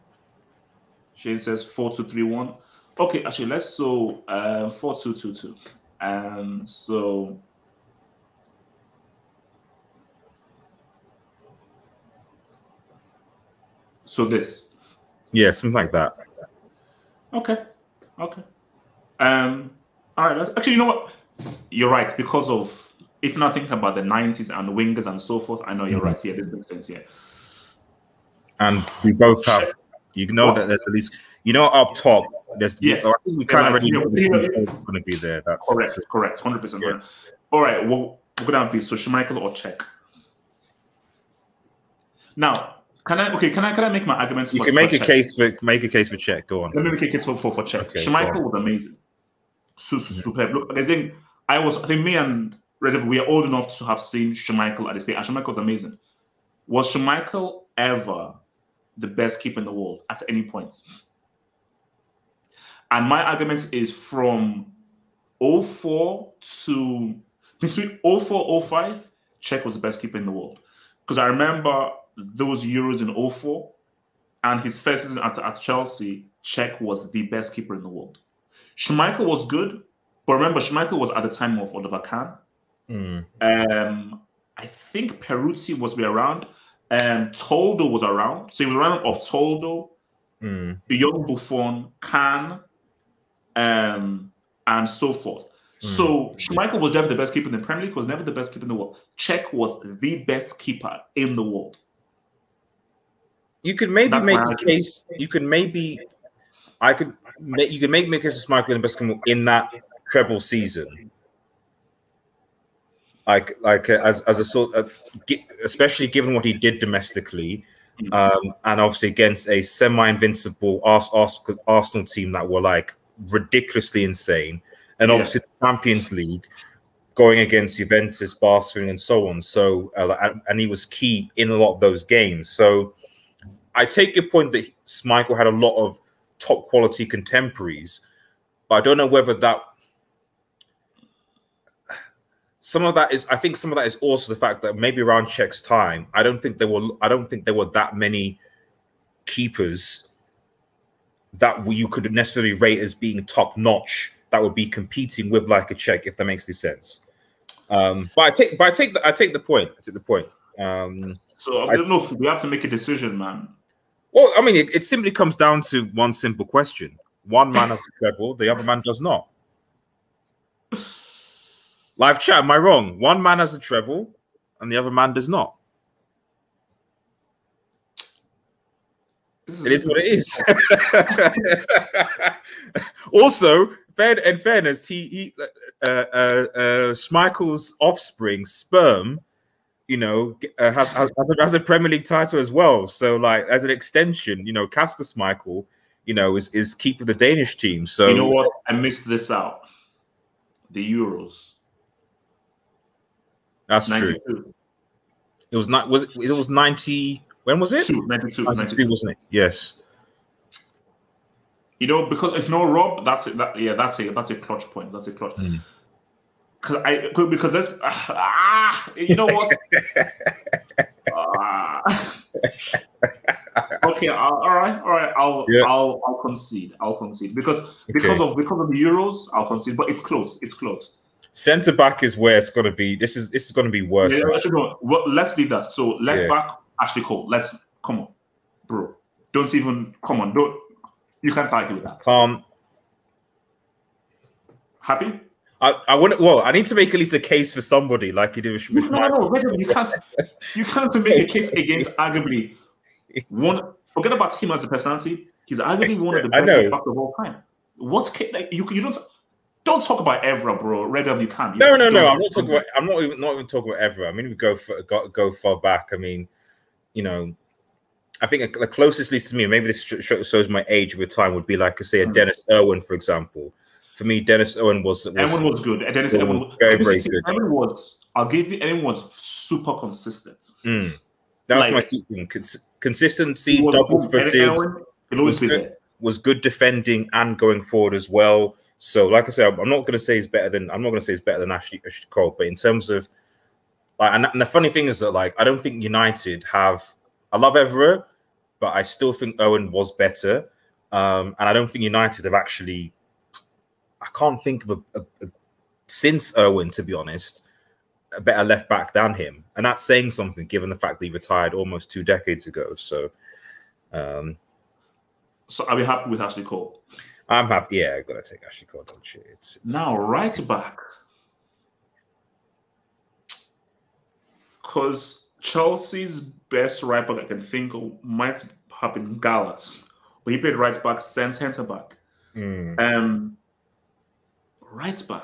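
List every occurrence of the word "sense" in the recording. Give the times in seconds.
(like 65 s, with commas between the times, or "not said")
26 s, 156 s.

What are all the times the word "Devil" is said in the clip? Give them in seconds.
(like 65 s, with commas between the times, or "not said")
261 s.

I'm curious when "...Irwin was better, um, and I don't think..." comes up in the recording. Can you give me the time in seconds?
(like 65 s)
299 s.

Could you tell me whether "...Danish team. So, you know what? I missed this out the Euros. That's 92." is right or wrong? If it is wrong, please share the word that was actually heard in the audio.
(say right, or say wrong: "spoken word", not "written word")
right.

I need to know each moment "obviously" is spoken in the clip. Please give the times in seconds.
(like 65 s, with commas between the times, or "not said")
118 s, 125 s.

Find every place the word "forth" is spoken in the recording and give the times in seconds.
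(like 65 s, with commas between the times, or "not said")
25 s, 95 s.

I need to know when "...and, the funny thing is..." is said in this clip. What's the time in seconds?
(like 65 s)
294 s.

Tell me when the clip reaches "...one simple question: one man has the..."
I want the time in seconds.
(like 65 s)
165 s.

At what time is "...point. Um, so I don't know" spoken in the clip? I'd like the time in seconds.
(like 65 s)
160 s.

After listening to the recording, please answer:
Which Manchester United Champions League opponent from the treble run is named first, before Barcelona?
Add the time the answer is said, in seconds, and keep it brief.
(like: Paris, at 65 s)
Juventus, at 127 s.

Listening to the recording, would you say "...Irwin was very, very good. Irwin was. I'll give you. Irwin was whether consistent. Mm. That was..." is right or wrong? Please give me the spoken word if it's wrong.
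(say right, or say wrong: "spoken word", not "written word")
wrong: "super", not "whether".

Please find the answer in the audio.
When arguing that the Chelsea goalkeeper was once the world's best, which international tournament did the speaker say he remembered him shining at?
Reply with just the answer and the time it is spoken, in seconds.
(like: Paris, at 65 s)
Euros in 04, at 72 s.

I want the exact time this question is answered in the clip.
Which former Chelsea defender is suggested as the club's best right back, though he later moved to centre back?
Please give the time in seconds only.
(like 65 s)
329 s.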